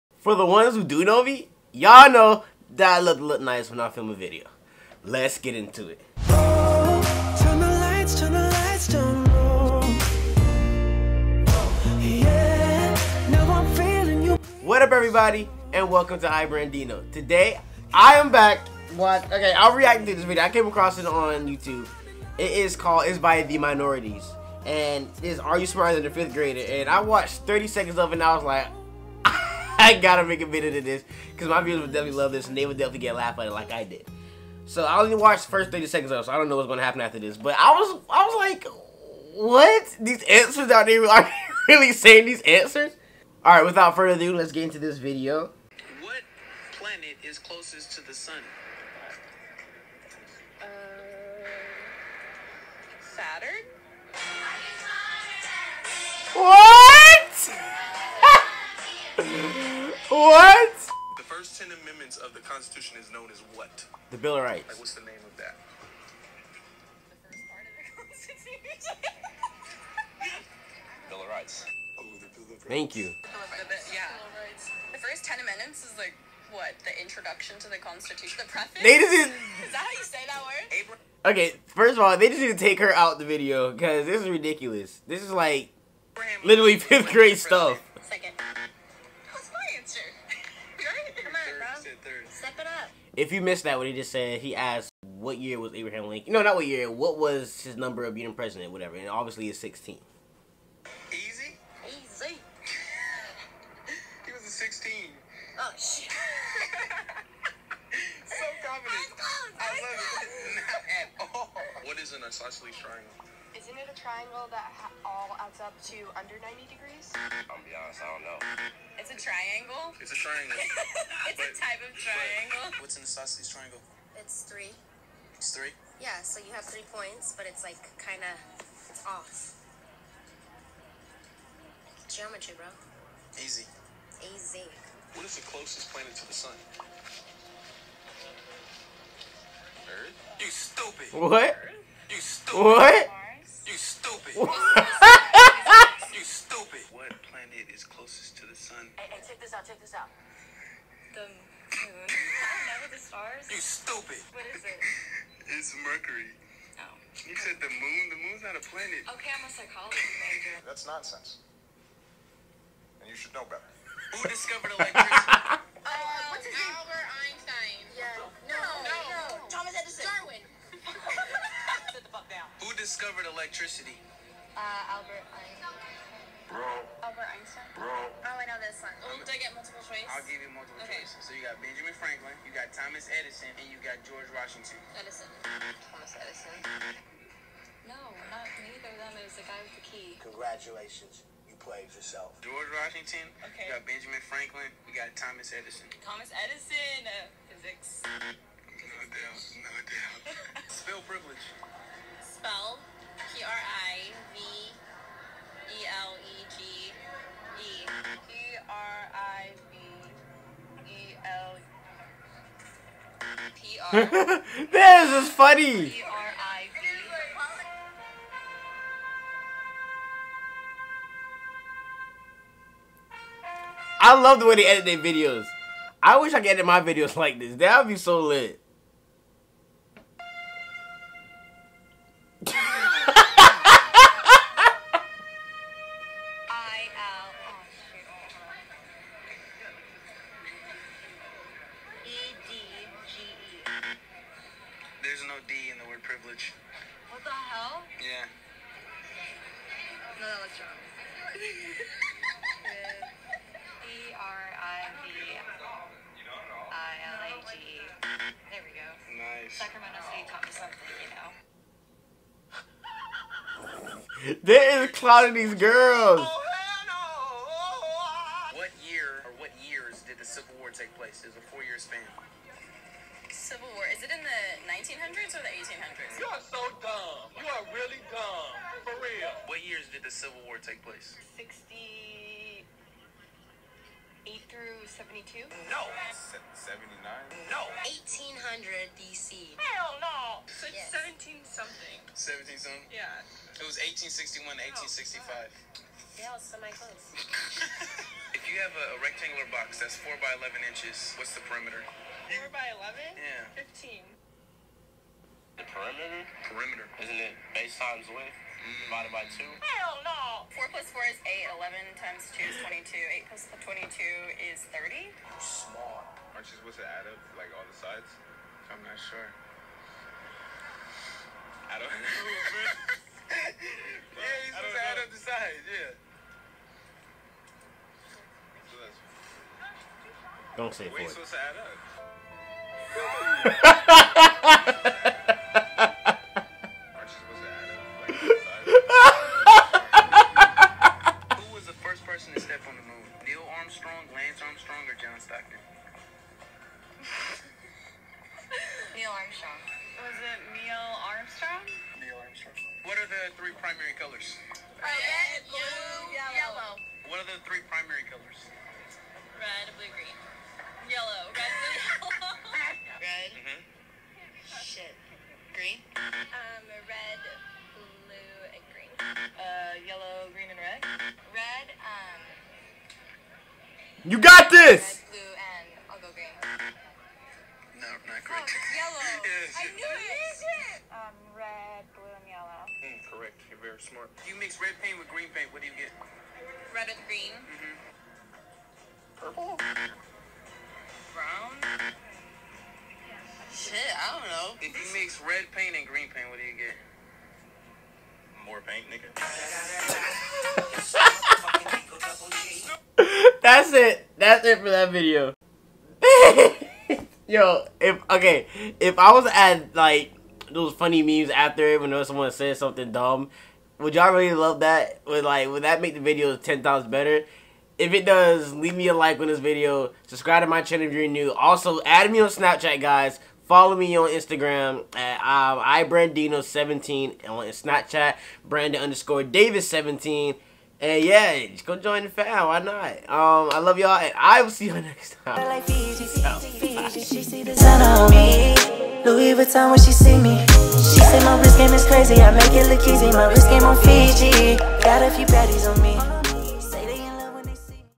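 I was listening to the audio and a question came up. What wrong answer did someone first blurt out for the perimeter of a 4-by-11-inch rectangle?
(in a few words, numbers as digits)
15.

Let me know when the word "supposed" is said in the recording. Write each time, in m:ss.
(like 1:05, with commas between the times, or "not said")
5:16, 5:24.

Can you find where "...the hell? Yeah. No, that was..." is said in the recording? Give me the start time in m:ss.
4:07.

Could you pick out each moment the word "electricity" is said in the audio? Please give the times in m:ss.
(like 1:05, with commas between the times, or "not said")
2:44, 2:53.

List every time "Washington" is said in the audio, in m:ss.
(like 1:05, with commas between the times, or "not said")
3:04, 3:12.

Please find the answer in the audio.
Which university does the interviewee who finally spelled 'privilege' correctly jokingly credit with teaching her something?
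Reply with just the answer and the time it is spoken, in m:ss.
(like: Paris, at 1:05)
Sacramento State, at 4:19.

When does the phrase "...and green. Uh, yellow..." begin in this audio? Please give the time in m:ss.
6:08.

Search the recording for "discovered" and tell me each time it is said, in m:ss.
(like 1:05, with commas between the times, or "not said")
2:44, 2:52.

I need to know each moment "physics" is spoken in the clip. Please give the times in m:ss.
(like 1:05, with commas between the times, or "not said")
3:17.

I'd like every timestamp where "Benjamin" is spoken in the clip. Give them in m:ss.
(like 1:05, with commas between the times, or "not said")
3:01, 3:13.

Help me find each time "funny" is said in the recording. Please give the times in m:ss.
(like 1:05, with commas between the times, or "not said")
3:35, 6:50.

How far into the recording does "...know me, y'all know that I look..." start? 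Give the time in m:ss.
0:01.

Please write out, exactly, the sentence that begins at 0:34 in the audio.
So I only watched the first 30 seconds of it, so I don't know what's gonna happen after this.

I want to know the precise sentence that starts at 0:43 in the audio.
Alright, without further ado, let's get into this video.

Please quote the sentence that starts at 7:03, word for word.
Follow me on Instagram at uh, iBrandino17 on Snapchat, Brandon underscore Davis17.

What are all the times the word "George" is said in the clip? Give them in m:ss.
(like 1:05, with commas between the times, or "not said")
3:04, 3:12.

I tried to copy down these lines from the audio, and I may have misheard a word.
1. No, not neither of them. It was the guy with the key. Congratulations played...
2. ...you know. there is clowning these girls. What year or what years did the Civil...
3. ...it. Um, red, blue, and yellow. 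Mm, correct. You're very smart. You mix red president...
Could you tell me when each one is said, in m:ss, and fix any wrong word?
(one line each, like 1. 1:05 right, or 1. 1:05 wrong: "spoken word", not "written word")
1. 3:07 right
2. 4:24 right
3. 6:19 wrong: "paint", not "president".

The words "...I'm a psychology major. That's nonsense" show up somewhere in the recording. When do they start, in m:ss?
2:39.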